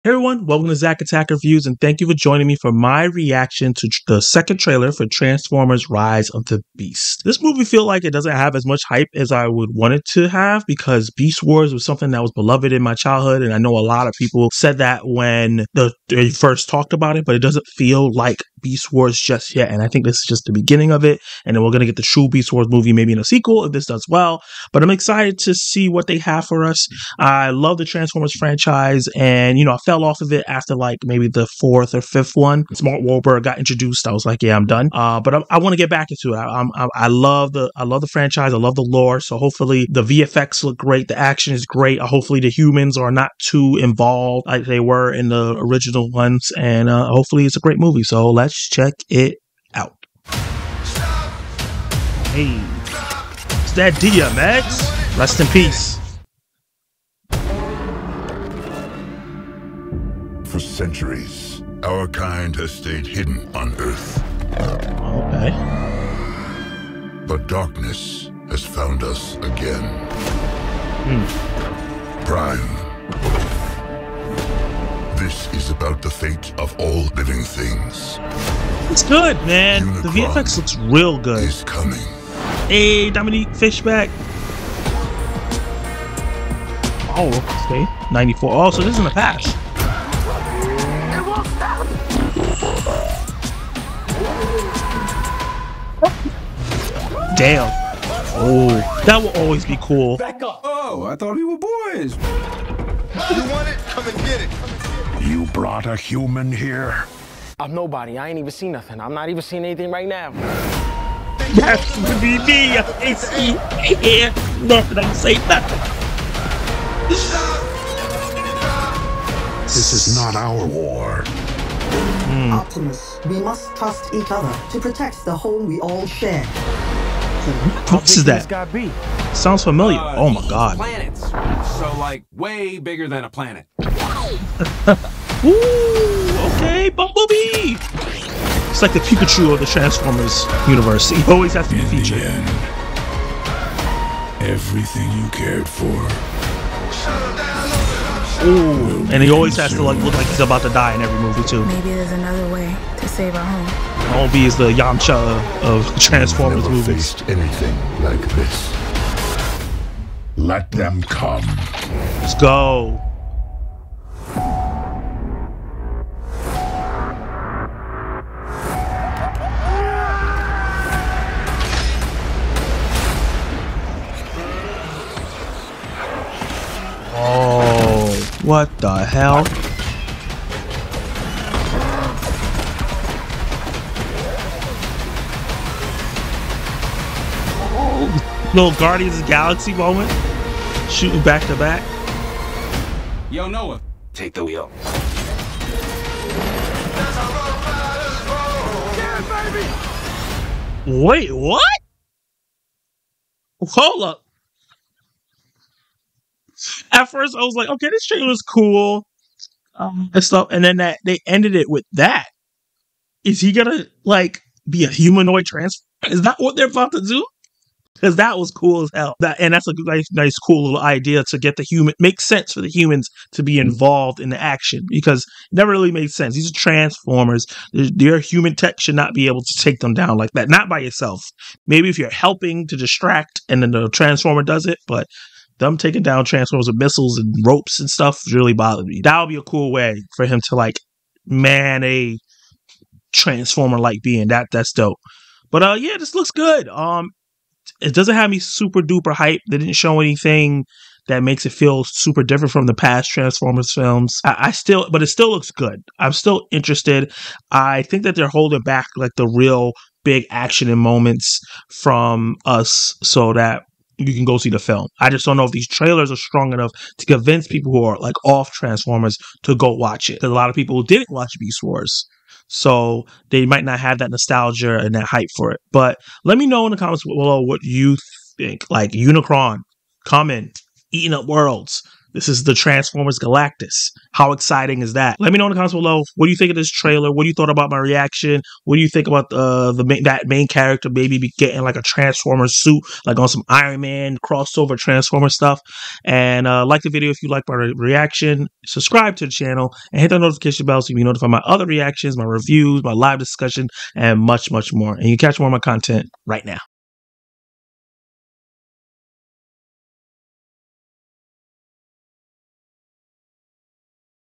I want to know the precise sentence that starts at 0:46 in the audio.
And uh, hopefully it's a great movie.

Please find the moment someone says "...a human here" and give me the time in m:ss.
1:45.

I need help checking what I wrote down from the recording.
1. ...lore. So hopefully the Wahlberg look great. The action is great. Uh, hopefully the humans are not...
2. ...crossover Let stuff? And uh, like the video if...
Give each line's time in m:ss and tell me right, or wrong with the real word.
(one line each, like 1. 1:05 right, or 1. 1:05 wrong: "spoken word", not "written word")
1. 0:38 wrong: "VFX", not "Wahlberg"
2. 4:54 wrong: "Transformer", not "Let".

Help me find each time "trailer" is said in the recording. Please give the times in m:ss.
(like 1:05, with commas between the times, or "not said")
0:04, 3:28, 4:25, 4:46.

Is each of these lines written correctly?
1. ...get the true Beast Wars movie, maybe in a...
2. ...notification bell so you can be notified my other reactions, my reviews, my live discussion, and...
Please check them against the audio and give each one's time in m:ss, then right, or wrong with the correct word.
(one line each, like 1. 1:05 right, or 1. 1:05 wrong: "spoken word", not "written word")
1. 0:21 right
2. 5:00 right.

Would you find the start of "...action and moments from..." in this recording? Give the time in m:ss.
4:20.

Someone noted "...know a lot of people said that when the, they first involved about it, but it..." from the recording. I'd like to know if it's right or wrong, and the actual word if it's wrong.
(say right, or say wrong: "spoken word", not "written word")
wrong: "talked", not "involved".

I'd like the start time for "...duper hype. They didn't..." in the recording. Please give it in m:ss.
4:08.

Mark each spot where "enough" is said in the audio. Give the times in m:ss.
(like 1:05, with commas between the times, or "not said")
4:26.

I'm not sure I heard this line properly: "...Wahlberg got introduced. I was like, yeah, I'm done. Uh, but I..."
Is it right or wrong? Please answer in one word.
right.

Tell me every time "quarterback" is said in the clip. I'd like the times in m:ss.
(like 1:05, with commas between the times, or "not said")
not said.